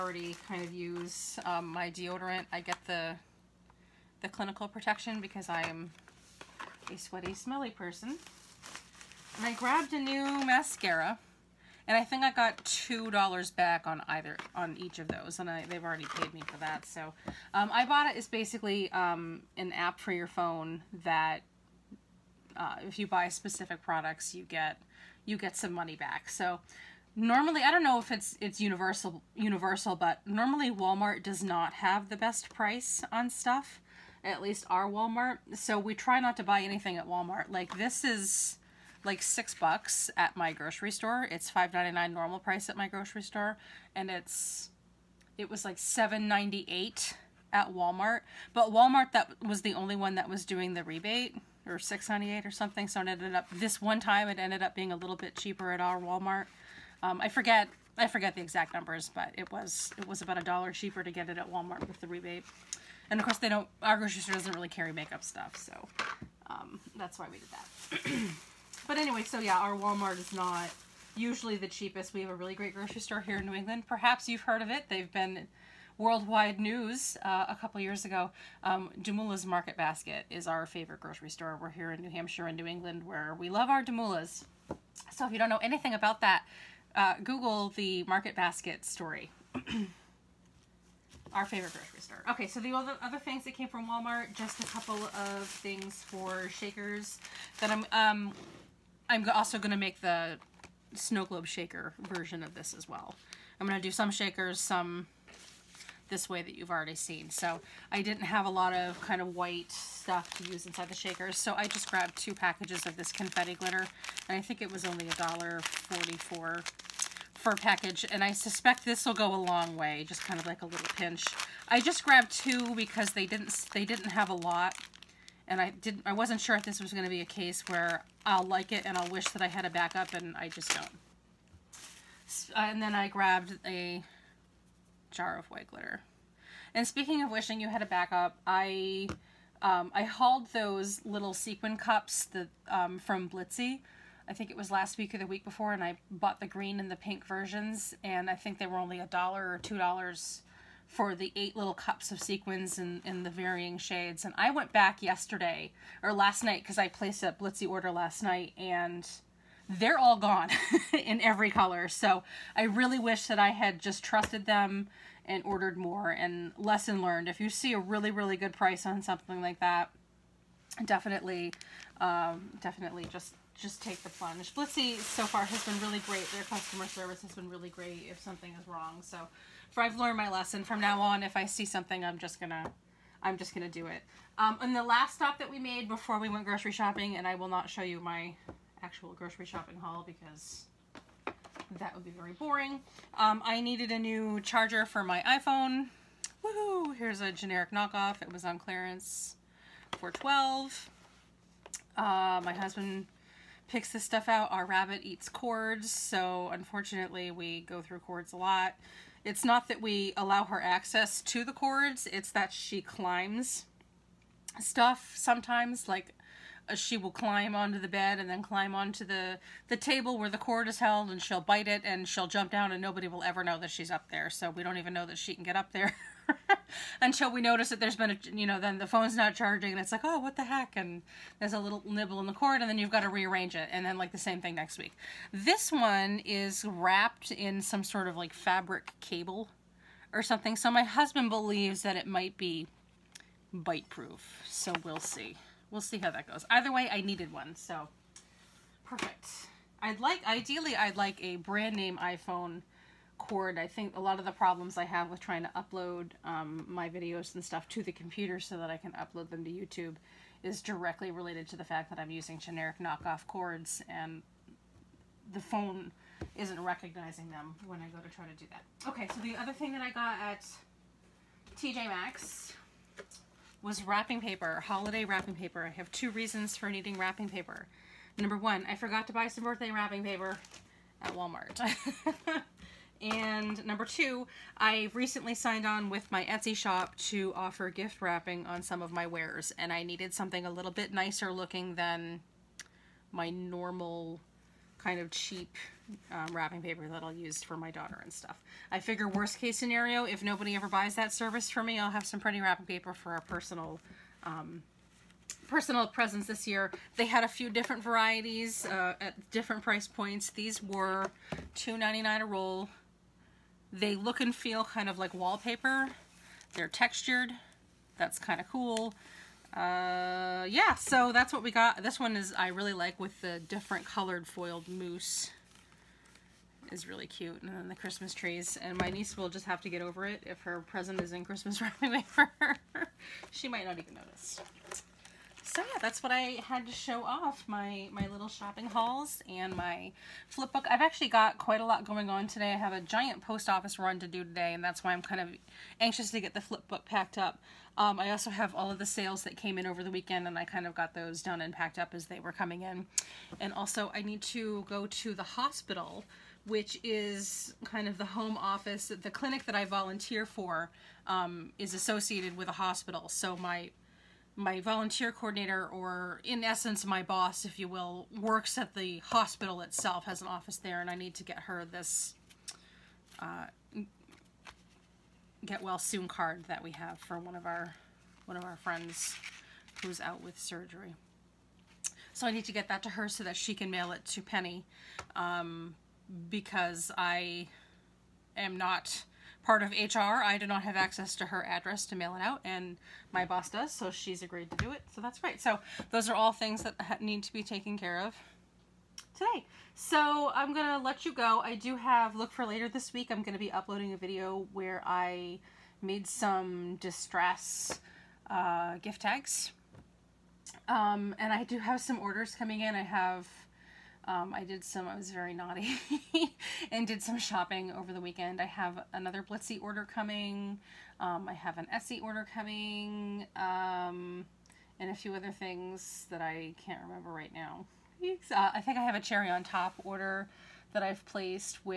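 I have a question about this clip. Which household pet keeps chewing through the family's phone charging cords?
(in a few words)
rabbit.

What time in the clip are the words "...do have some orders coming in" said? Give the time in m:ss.
6:51.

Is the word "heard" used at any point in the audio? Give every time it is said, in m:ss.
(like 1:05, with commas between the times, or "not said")
1:14.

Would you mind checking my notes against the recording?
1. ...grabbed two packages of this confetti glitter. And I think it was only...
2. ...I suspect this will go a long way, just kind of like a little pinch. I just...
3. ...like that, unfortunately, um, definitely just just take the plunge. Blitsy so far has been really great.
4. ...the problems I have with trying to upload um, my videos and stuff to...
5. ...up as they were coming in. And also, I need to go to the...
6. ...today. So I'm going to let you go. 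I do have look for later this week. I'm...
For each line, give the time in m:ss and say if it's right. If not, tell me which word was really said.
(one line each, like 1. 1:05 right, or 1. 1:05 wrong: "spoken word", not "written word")
1. 1:51 right
2. 1:58 right
3. 2:49 wrong: "definitely", not "unfortunately"
4. 4:14 right
5. 5:51 right
6. 6:39 right.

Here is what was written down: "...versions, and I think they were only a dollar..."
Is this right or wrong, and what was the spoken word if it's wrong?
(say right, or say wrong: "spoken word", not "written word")
right.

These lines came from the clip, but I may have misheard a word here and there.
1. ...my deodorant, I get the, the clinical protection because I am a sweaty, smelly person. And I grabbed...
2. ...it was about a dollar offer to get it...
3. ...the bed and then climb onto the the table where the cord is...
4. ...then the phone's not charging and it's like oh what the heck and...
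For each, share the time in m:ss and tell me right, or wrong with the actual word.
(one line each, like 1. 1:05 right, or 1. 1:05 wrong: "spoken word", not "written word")
1. 0:01 right
2. 0:59 wrong: "cheaper", not "offer"
3. 3:37 right
4. 3:48 right.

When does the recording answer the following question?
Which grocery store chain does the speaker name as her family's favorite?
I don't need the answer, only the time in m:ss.
1:19.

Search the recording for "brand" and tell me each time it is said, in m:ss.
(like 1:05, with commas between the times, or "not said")
4:11.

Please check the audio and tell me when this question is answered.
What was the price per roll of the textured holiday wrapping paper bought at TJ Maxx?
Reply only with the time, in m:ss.
5:11.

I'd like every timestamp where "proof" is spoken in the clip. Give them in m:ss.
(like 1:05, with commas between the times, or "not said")
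4:03.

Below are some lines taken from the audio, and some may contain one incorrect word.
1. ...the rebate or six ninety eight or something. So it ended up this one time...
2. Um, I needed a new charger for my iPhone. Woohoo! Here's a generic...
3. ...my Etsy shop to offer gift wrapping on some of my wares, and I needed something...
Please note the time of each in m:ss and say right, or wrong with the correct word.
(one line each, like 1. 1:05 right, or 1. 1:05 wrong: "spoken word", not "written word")
1. 0:50 right
2. 3:13 right
3. 4:46 right.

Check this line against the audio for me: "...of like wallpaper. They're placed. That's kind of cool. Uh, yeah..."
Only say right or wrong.
wrong.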